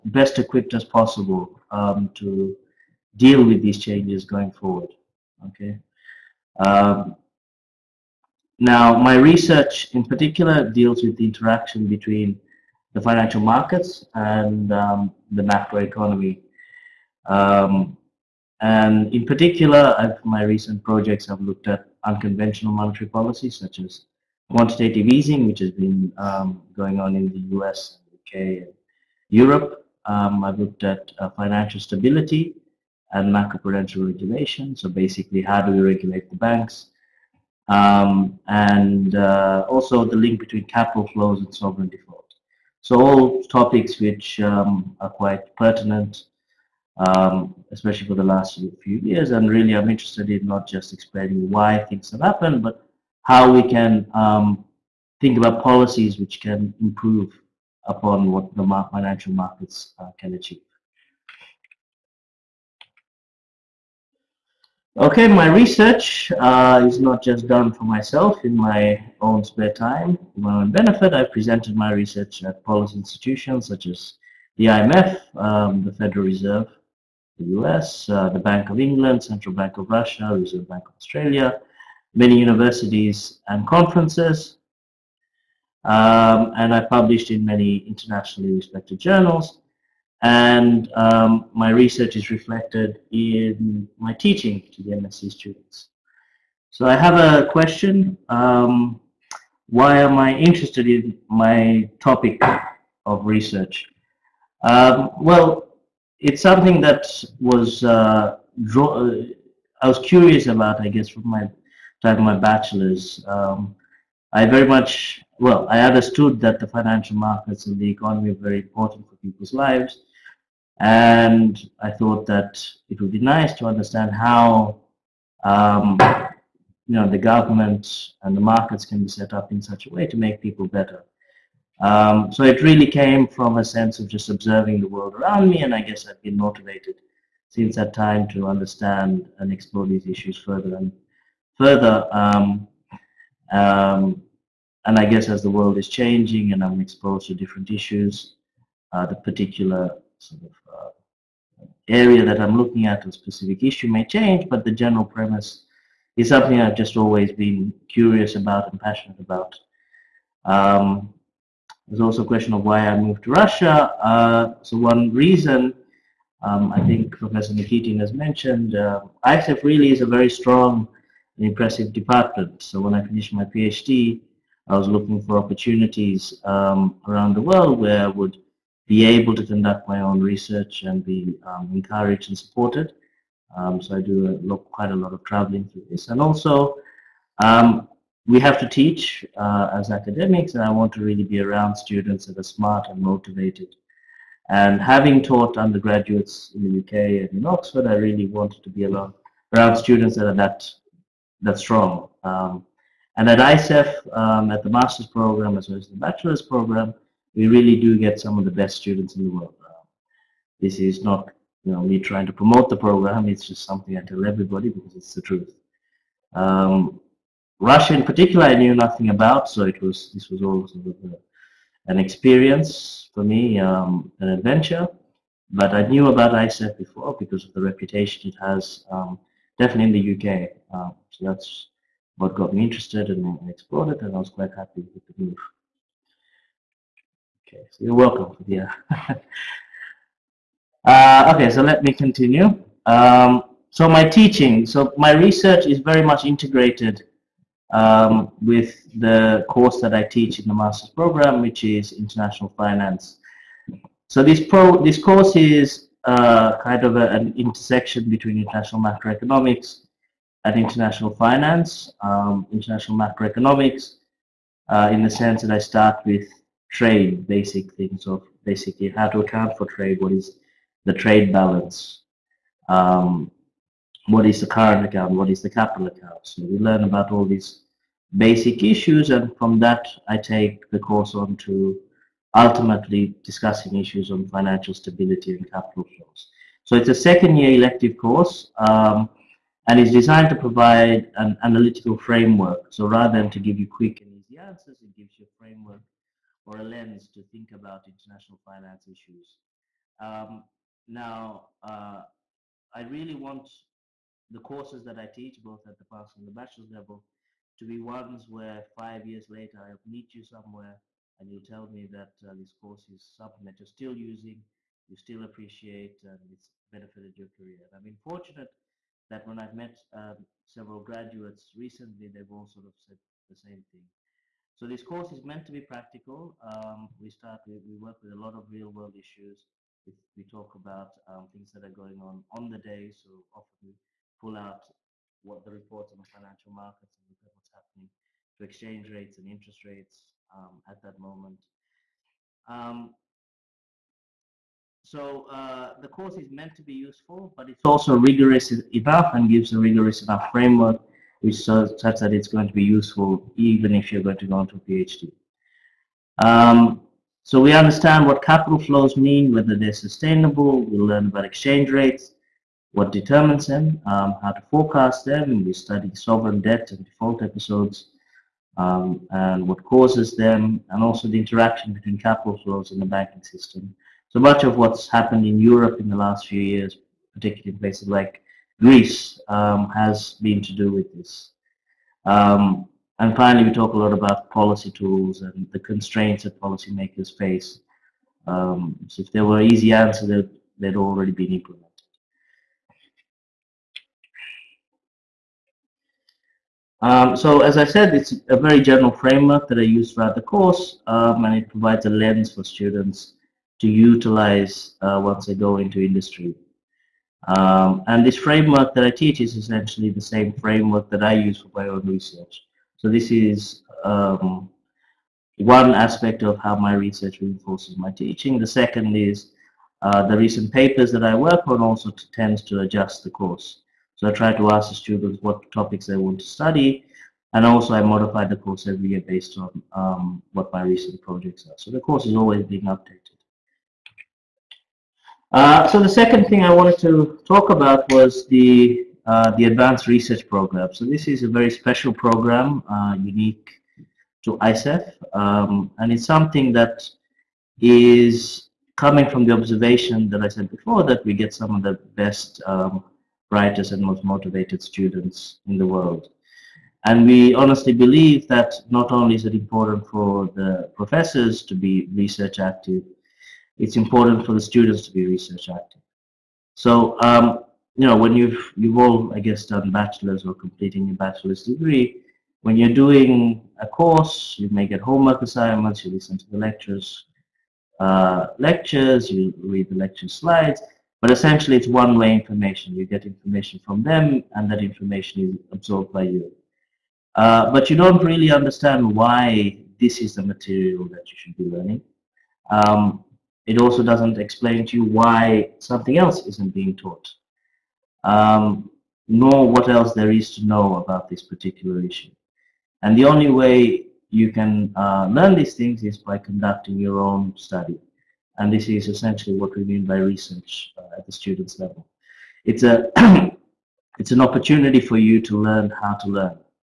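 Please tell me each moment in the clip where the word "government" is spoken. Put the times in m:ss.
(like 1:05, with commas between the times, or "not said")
2:07.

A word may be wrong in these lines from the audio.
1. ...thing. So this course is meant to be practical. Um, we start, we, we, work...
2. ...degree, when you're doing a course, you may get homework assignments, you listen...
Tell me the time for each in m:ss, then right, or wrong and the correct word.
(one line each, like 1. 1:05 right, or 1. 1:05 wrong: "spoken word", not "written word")
1. 5:23 right
2. 7:51 right.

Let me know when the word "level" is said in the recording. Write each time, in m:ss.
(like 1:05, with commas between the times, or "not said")
5:06, 8:31.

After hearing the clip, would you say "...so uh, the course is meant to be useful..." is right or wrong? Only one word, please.
right.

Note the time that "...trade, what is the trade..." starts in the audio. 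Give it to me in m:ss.
4:29.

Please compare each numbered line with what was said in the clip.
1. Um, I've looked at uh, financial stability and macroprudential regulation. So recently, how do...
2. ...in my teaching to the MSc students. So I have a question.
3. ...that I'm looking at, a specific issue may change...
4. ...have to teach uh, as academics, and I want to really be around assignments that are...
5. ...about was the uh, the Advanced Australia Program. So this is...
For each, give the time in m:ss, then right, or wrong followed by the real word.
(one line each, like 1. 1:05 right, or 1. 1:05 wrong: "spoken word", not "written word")
1. 0:30 wrong: "basically", not "recently"
2. 1:33 right
3. 2:32 right
4. 3:08 wrong: "students", not "assignments"
5. 7:17 wrong: "Research", not "Australia".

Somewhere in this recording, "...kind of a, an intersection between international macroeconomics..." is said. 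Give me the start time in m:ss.
4:16.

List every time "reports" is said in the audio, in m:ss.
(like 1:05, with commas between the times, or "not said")
5:35.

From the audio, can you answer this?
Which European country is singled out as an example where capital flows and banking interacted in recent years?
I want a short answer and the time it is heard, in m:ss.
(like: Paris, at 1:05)
Greece, at 6:18.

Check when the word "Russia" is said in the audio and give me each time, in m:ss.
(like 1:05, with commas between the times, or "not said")
1:19, 2:43, 3:37.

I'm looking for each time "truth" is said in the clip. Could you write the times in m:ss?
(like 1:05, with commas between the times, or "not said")
3:35.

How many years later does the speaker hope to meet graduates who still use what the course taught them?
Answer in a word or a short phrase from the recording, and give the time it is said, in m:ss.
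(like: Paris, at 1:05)
5, at 5:08.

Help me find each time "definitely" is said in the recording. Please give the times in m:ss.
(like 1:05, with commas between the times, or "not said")
3:49.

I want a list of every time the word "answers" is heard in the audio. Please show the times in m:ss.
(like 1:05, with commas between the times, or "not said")
4:54, 6:29.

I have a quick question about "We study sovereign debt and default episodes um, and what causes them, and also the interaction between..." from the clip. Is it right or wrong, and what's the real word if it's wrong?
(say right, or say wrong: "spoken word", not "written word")
right.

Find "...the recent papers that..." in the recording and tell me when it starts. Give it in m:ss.
7:00.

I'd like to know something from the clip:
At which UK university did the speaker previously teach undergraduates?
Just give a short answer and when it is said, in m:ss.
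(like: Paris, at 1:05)
Oxford, at 3:17.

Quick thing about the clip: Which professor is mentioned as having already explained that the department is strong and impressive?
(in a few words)
Professor Nikitin.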